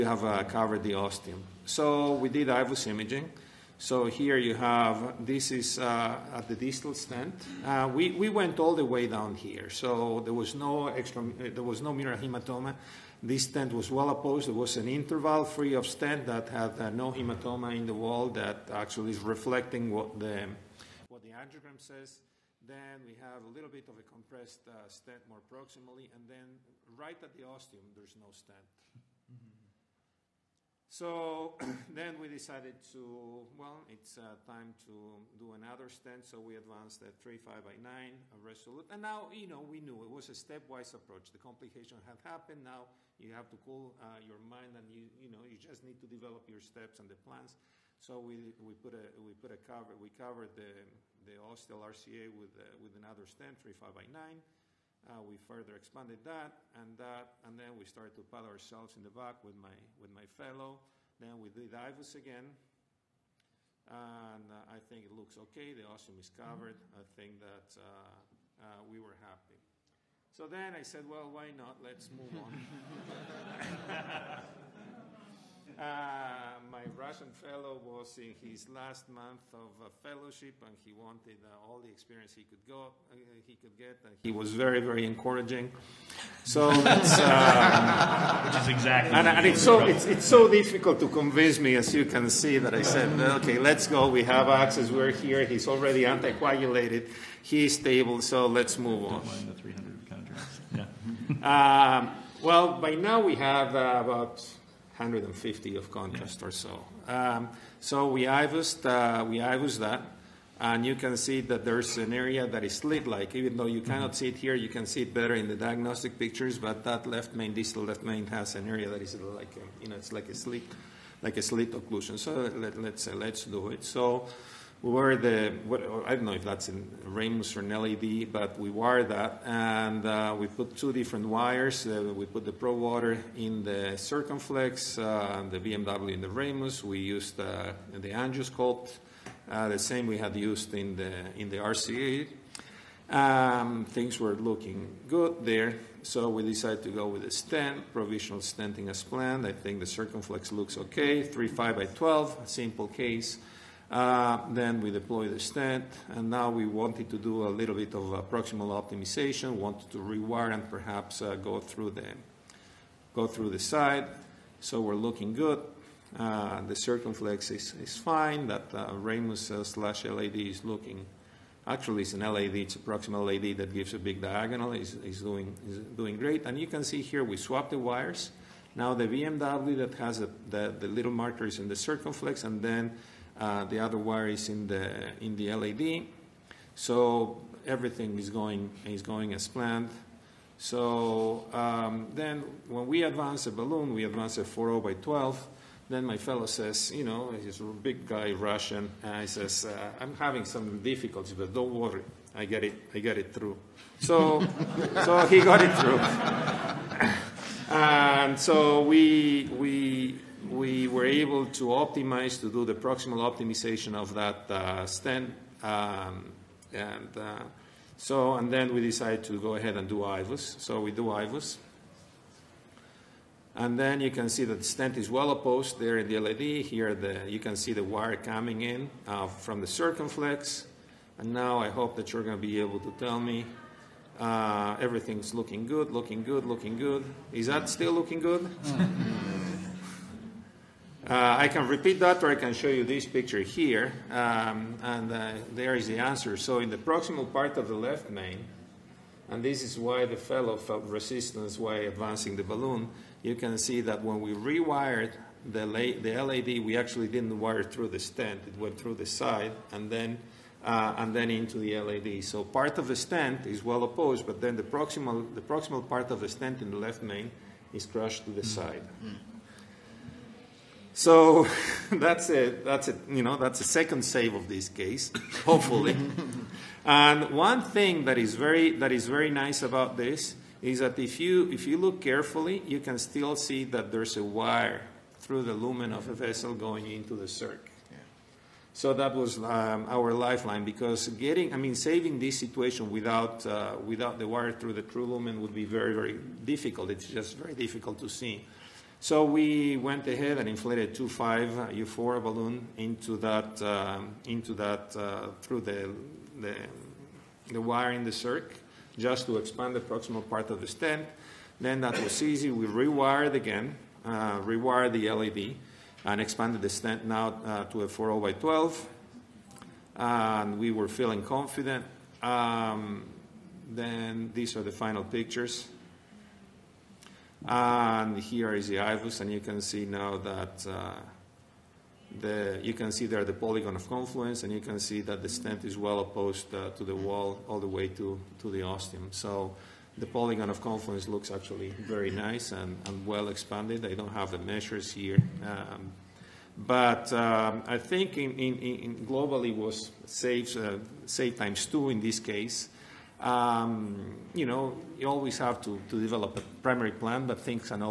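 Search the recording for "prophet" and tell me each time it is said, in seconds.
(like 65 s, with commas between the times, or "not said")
not said.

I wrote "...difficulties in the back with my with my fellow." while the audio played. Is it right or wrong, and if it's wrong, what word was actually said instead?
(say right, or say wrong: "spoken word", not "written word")
wrong: "ourselves", not "difficulties".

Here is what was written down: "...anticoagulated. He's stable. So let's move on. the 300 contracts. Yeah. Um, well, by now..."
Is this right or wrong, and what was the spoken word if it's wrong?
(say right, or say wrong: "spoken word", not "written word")
right.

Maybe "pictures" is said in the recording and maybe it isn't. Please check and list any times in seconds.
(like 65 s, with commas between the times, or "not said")
116 s, 243 s, 325 s.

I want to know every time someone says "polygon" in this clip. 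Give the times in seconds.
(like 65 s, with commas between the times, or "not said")
333 s, 340 s.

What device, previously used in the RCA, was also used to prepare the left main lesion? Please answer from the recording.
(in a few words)
Angiosculpt.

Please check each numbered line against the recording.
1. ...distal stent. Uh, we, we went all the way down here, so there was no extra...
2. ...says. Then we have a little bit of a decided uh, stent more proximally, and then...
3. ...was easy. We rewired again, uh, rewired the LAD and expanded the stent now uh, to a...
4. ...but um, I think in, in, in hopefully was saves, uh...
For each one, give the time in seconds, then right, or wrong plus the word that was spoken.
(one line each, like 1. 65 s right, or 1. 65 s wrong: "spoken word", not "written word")
1. 6 s right
2. 21 s wrong: "compressed", not "decided"
3. 312 s right
4. 346 s wrong: "globally", not "hopefully".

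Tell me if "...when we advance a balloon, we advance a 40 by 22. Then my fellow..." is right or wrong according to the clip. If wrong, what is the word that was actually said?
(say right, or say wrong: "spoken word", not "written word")
wrong: "12", not "22".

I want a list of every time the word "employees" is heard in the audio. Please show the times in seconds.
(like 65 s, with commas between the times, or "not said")
not said.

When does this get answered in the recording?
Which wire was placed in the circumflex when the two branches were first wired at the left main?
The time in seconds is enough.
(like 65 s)
132 s.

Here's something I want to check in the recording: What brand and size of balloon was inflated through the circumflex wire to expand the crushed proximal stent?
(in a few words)
2.5 Euphora.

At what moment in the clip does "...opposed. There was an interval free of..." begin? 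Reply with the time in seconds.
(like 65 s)
14 s.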